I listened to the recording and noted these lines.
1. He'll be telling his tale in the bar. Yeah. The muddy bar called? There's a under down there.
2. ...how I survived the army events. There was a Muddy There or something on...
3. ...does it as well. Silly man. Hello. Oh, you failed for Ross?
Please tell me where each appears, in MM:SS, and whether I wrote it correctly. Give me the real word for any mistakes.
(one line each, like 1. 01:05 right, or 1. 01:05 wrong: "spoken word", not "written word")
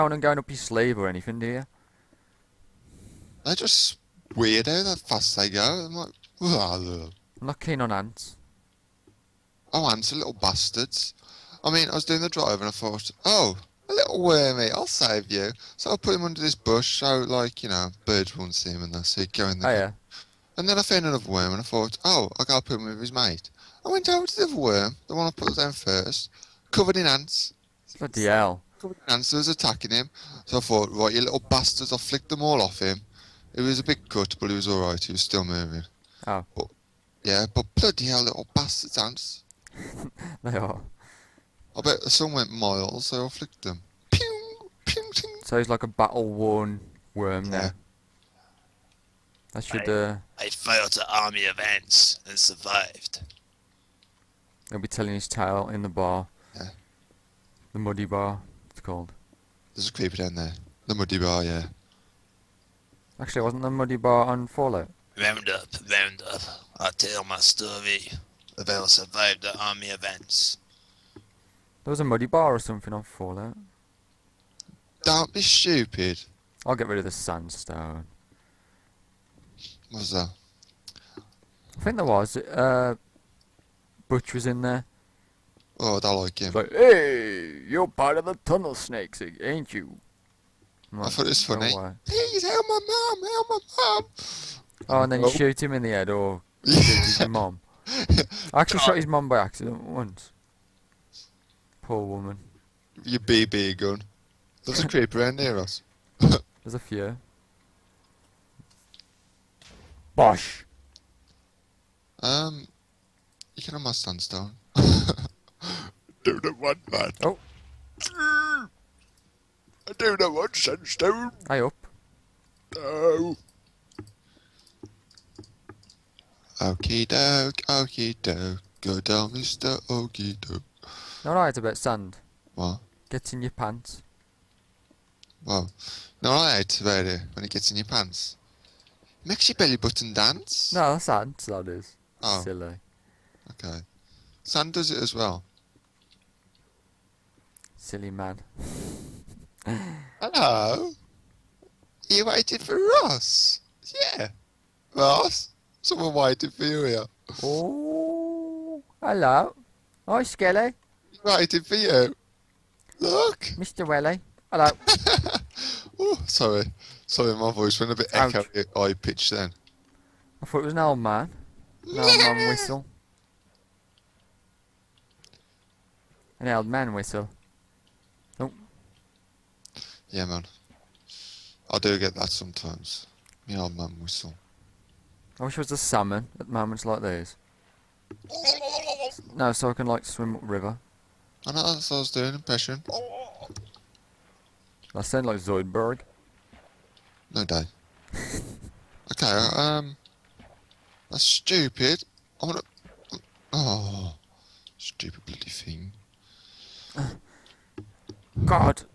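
1. 00:54 wrong: "creeper", not "under"
2. 01:08 wrong: "Bar", not "There"
3. 02:24 wrong: "waited", not "failed".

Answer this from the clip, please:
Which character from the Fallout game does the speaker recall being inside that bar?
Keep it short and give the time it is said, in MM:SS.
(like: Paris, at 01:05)
Butch, at 01:24.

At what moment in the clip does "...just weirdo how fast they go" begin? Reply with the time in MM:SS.
00:03.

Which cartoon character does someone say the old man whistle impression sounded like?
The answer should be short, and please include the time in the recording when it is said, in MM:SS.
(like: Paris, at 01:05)
Zoidberg, at 03:15.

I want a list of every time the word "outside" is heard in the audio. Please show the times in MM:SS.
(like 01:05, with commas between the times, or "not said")
not said.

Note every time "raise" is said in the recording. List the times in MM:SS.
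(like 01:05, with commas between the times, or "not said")
not said.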